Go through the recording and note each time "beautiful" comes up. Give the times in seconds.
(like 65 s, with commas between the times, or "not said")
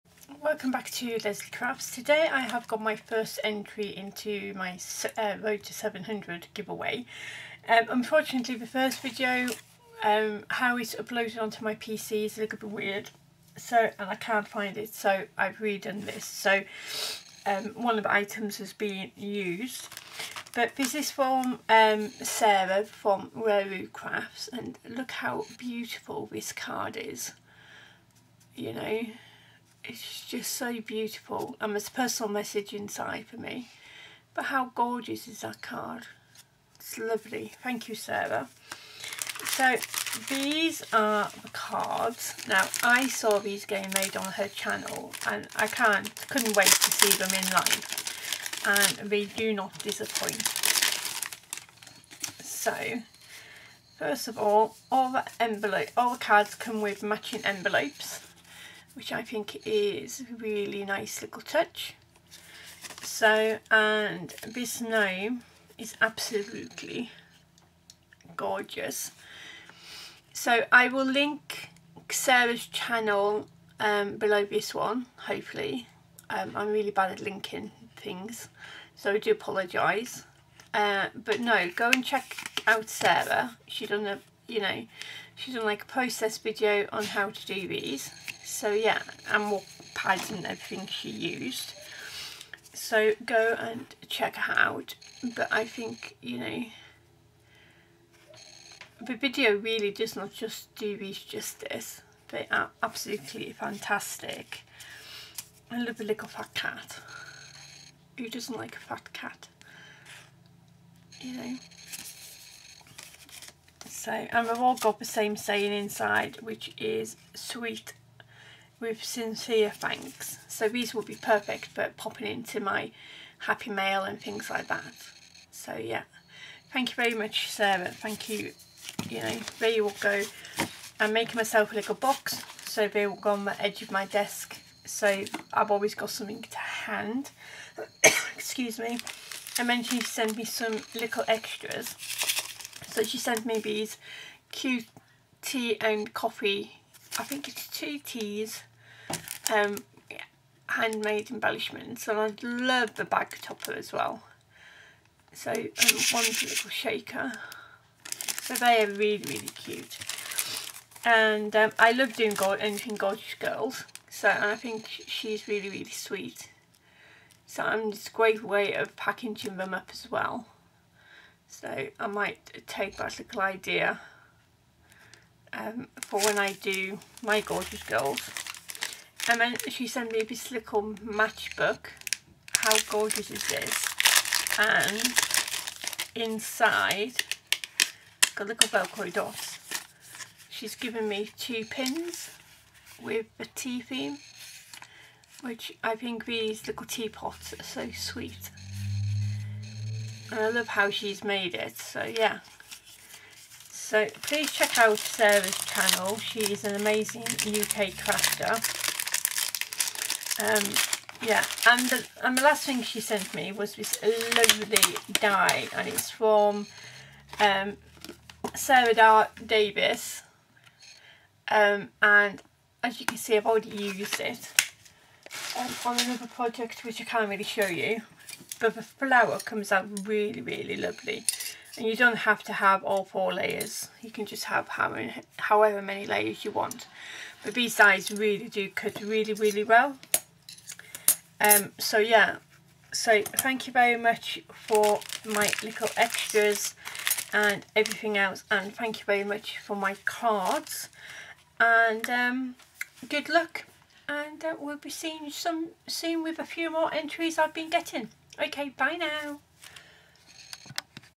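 25 s, 30 s.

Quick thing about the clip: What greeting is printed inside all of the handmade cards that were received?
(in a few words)
with sincere thanks.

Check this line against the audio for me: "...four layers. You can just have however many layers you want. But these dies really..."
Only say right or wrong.
right.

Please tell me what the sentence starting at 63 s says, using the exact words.
So, and this gnome is absolutely gorgeous.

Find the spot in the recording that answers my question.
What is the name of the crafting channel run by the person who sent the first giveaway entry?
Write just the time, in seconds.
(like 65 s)
23 s.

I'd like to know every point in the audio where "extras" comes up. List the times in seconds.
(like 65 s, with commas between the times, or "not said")
141 s, 245 s.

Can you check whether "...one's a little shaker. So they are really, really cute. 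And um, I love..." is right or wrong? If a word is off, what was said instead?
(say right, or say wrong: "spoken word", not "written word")
right.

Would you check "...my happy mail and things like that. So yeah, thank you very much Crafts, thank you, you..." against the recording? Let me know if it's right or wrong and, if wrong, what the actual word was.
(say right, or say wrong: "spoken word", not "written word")
wrong: "Sarah", not "Crafts".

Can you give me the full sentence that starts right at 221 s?
Um, and as you can see, I've already used it um, on another project, which I can't really show you.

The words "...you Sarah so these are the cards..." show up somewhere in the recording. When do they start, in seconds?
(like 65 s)
37 s.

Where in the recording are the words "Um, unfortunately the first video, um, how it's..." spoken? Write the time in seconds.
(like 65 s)
7 s.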